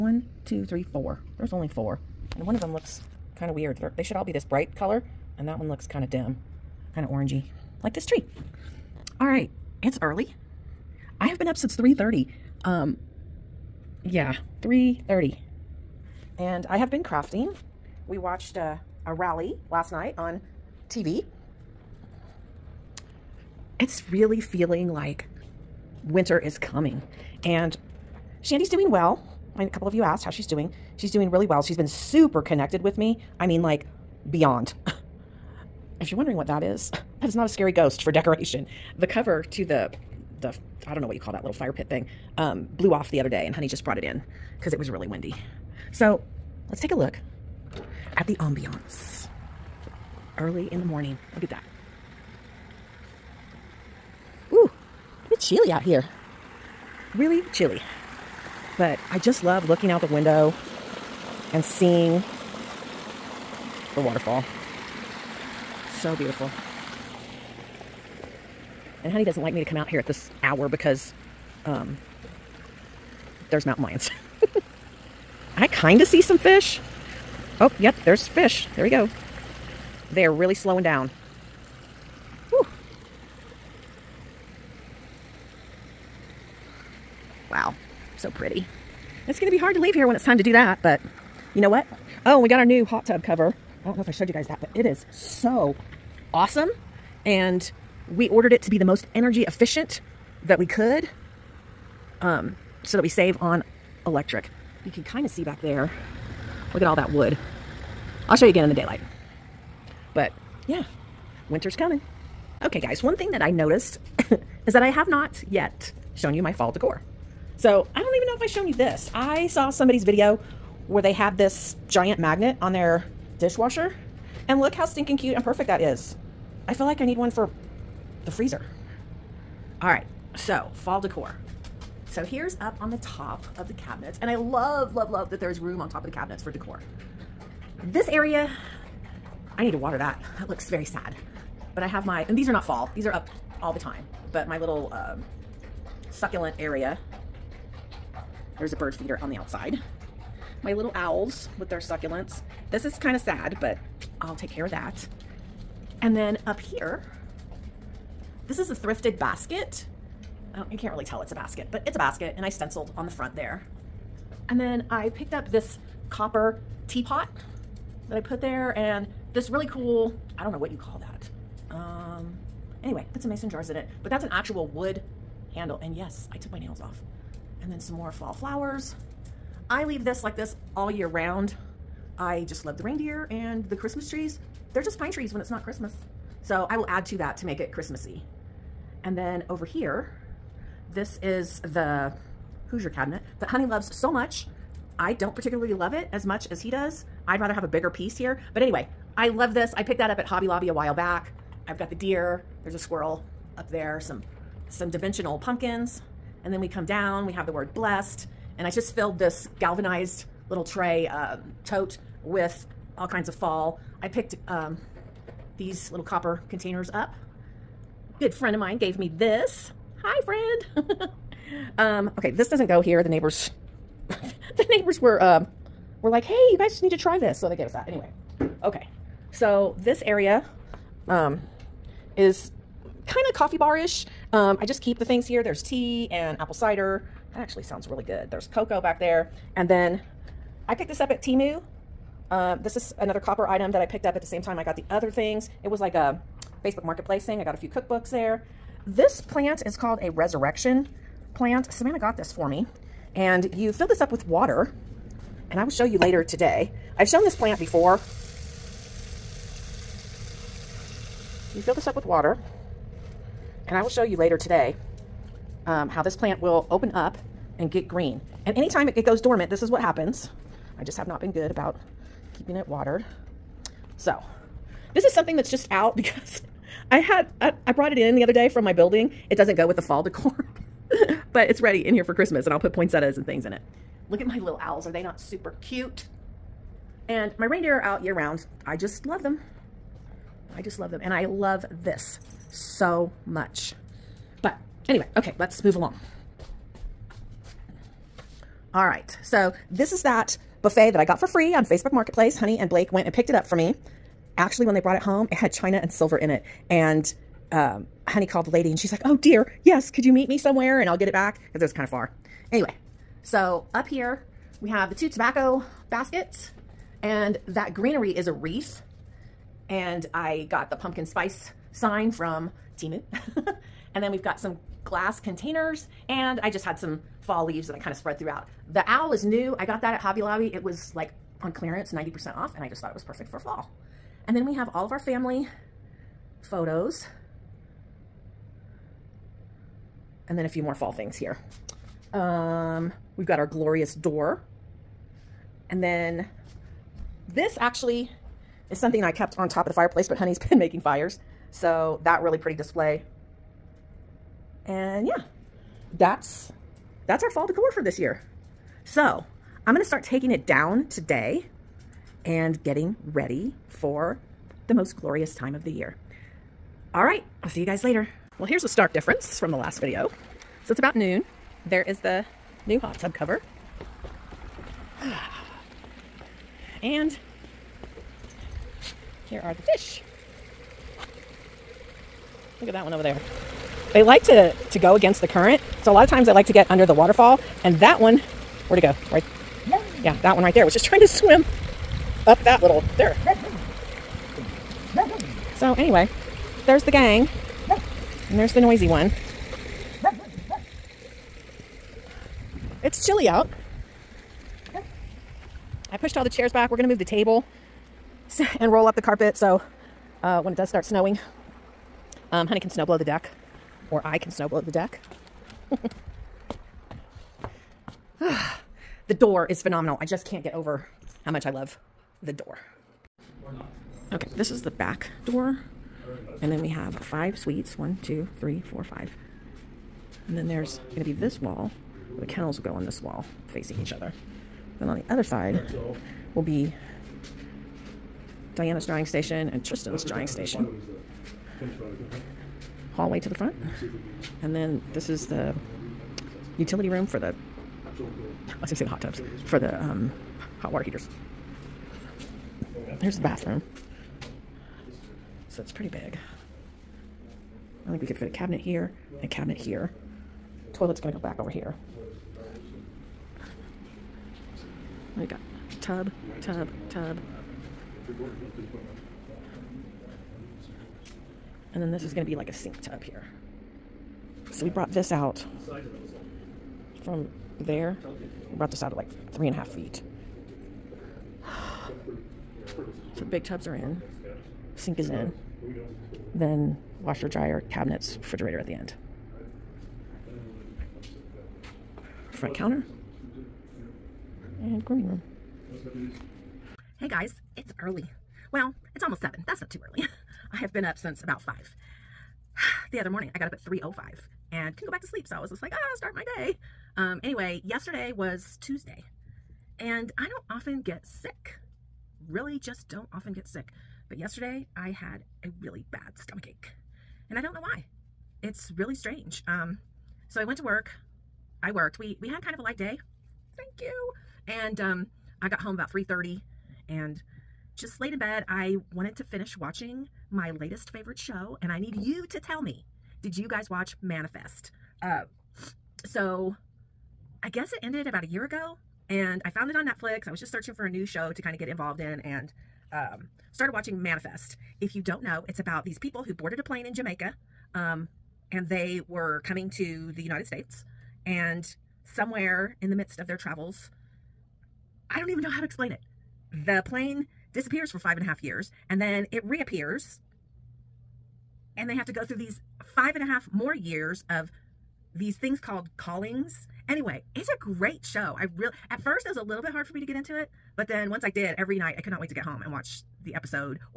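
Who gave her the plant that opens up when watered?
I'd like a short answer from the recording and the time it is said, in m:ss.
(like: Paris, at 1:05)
Savannah, at 4:11.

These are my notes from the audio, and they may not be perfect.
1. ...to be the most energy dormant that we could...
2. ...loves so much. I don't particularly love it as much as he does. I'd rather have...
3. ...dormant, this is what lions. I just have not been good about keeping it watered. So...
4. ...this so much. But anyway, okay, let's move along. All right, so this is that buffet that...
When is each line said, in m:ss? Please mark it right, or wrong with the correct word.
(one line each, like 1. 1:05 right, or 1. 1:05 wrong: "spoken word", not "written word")
1. 1:38 wrong: "efficient", not "dormant"
2. 3:13 right
3. 4:29 wrong: "happens", not "lions"
4. 4:51 right.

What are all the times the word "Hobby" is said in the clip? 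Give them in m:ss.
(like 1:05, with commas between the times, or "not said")
3:20, 5:29.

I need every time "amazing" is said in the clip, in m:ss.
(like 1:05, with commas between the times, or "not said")
not said.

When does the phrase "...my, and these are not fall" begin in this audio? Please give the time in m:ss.
2:22.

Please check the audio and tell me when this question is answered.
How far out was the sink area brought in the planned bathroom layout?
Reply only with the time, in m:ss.
7:59.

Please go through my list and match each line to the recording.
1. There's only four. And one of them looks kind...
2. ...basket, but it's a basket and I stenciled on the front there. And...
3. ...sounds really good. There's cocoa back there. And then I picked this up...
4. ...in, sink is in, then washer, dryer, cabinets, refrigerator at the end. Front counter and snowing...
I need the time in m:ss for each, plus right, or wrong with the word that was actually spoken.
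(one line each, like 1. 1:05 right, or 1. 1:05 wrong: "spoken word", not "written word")
1. 0:01 right
2. 2:41 right
3. 3:57 right
4. 8:03 wrong: "grooming", not "snowing".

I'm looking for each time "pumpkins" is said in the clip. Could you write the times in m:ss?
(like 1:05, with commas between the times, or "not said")
3:25, 5:20.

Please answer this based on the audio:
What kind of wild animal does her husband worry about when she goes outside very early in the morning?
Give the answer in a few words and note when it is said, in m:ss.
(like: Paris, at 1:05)
Mountain lions, at 1:13.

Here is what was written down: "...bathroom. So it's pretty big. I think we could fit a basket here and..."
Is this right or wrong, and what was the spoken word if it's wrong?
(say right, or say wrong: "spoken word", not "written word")
wrong: "cabinet", not "basket".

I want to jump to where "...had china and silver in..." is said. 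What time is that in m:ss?
5:05.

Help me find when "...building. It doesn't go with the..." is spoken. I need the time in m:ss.
4:38.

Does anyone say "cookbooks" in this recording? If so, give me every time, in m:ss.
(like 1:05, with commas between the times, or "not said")
4:07.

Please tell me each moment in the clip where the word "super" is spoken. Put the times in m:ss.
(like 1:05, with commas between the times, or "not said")
0:31, 4:45.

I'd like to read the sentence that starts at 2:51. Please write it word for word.
Um, anyway, put some mason jars in it, but that's an actual wood handle.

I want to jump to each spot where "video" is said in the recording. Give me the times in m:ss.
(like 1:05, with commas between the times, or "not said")
2:00, 6:09.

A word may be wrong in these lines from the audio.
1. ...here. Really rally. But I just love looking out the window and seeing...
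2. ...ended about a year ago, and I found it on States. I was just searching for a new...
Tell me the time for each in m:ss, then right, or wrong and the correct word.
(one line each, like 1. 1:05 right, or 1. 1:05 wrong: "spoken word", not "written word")
1. 0:55 wrong: "chilly", not "rally"
2. 8:57 wrong: "Netflix", not "States".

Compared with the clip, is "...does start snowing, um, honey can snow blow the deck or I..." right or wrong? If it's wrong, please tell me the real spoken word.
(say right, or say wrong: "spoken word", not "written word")
right.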